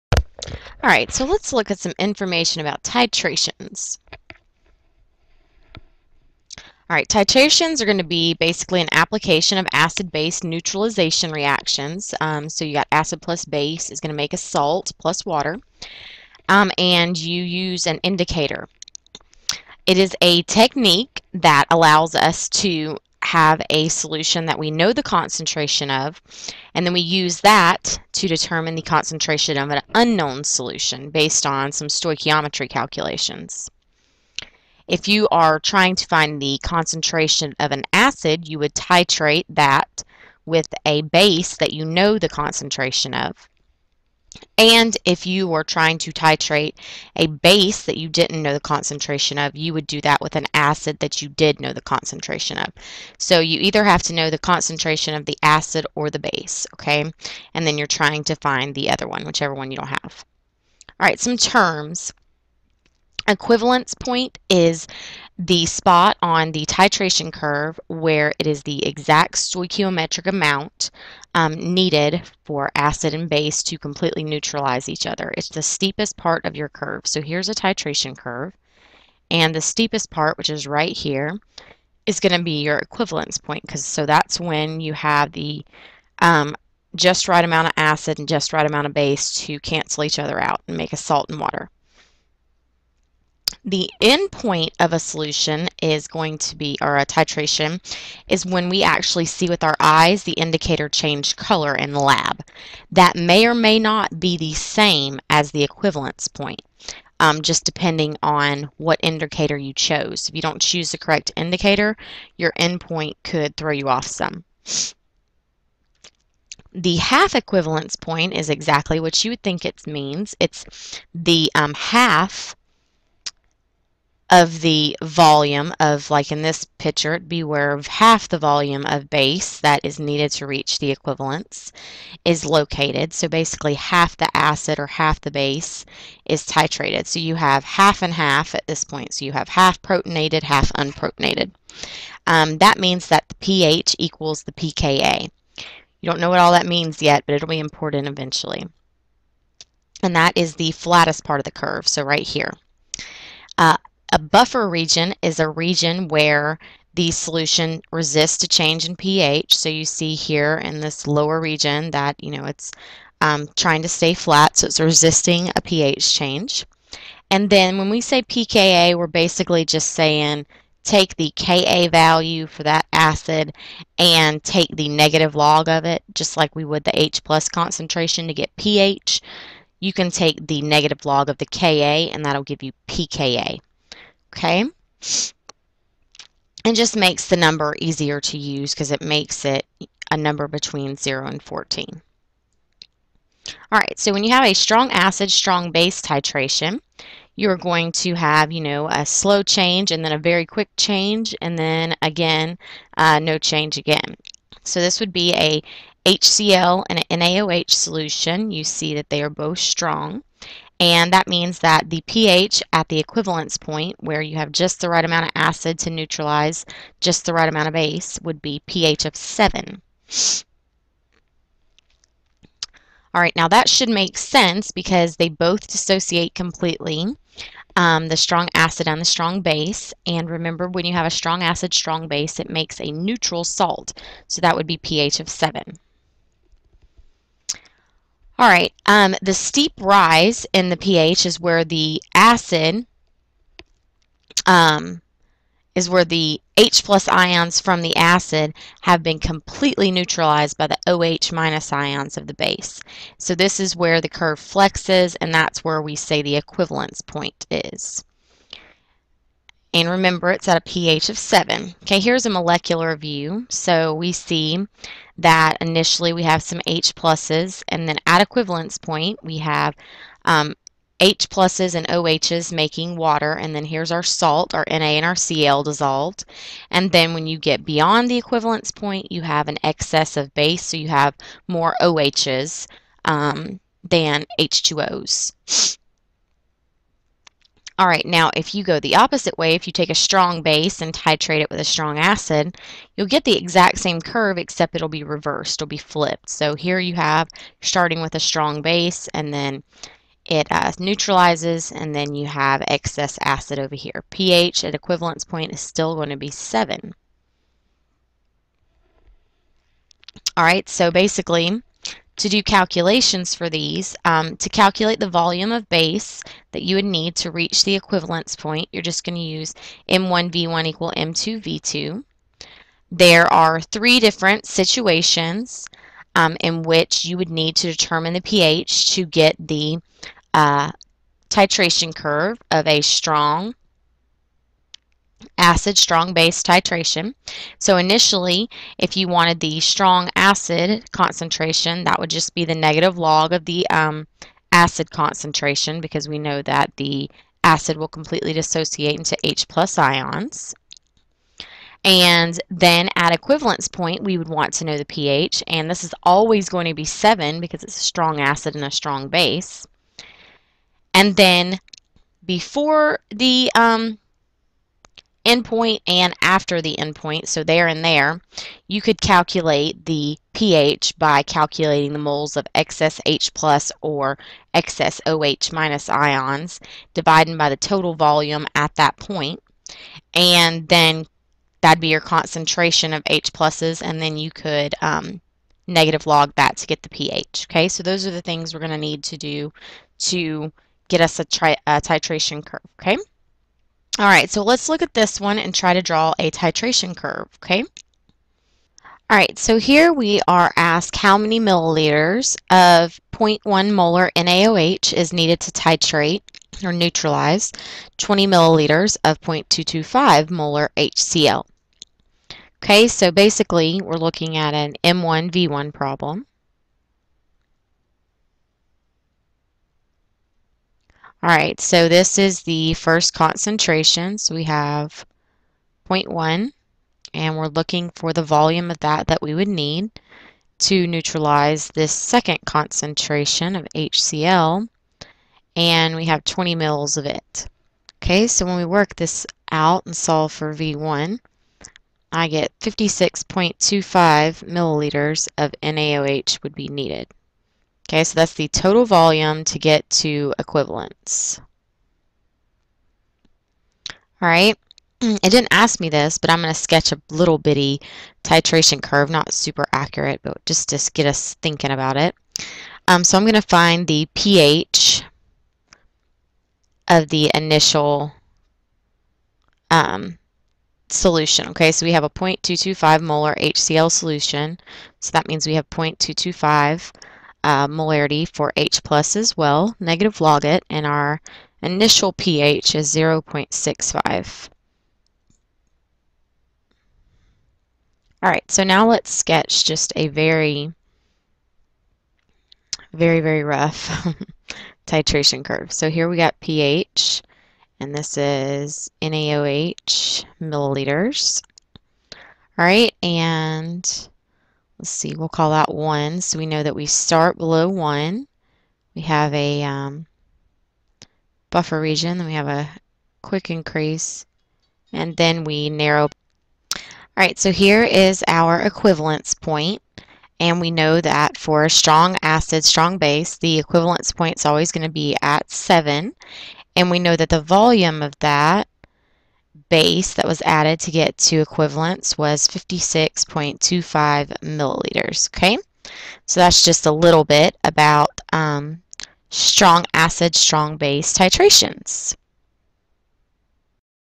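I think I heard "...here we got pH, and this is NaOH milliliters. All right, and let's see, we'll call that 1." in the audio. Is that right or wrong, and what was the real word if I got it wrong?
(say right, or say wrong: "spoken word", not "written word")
right.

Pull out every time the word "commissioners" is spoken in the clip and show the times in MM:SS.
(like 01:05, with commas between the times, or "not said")
not said.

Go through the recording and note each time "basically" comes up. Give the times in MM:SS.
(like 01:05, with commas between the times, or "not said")
00:08, 02:13, 02:49, 05:10, 06:53.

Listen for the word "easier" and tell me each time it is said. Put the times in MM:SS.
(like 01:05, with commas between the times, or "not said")
03:07.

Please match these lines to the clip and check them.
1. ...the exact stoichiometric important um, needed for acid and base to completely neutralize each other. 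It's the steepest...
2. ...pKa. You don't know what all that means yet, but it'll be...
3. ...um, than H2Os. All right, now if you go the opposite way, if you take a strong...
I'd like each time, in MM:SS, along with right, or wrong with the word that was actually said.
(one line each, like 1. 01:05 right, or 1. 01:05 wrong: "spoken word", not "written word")
1. 01:08 wrong: "amount", not "important"
2. 02:24 right
3. 04:43 right.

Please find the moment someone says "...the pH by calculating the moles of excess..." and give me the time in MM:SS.
06:09.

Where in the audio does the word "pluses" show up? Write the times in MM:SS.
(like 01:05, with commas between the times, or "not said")
04:26, 04:31, 06:23.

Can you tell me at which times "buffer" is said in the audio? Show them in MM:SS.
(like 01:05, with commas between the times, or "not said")
02:34, 08:31.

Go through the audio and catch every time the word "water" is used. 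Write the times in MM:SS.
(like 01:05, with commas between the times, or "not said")
00:15, 01:31, 04:32.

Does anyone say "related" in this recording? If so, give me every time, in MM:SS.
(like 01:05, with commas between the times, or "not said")
not said.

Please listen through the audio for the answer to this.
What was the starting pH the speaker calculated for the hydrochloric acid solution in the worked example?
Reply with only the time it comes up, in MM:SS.
08:02.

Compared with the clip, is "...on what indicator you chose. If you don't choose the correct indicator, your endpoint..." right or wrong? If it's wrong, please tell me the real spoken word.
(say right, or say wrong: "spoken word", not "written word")
right.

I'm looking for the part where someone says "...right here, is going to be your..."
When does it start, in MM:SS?
01:20.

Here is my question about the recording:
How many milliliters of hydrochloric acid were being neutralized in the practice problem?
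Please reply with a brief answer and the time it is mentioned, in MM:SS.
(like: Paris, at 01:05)
20 milliliters, at 06:47.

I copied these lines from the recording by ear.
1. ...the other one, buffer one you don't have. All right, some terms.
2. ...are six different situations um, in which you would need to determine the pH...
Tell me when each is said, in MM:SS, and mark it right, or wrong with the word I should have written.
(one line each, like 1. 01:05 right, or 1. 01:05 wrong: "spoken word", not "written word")
1. 00:58 wrong: "whichever", not "buffer"
2. 05:23 wrong: "three", not "six".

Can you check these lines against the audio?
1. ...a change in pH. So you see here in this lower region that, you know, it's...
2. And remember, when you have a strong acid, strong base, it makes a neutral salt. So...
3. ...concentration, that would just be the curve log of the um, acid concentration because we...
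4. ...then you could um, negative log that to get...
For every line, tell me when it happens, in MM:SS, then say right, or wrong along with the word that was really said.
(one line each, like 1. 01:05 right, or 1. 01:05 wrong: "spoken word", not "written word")
1. 02:38 right
2. 03:50 right
3. 05:40 wrong: "negative", not "curve"
4. 06:24 right.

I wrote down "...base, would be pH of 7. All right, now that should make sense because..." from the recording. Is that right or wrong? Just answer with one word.
right.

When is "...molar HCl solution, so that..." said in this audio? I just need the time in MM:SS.
07:53.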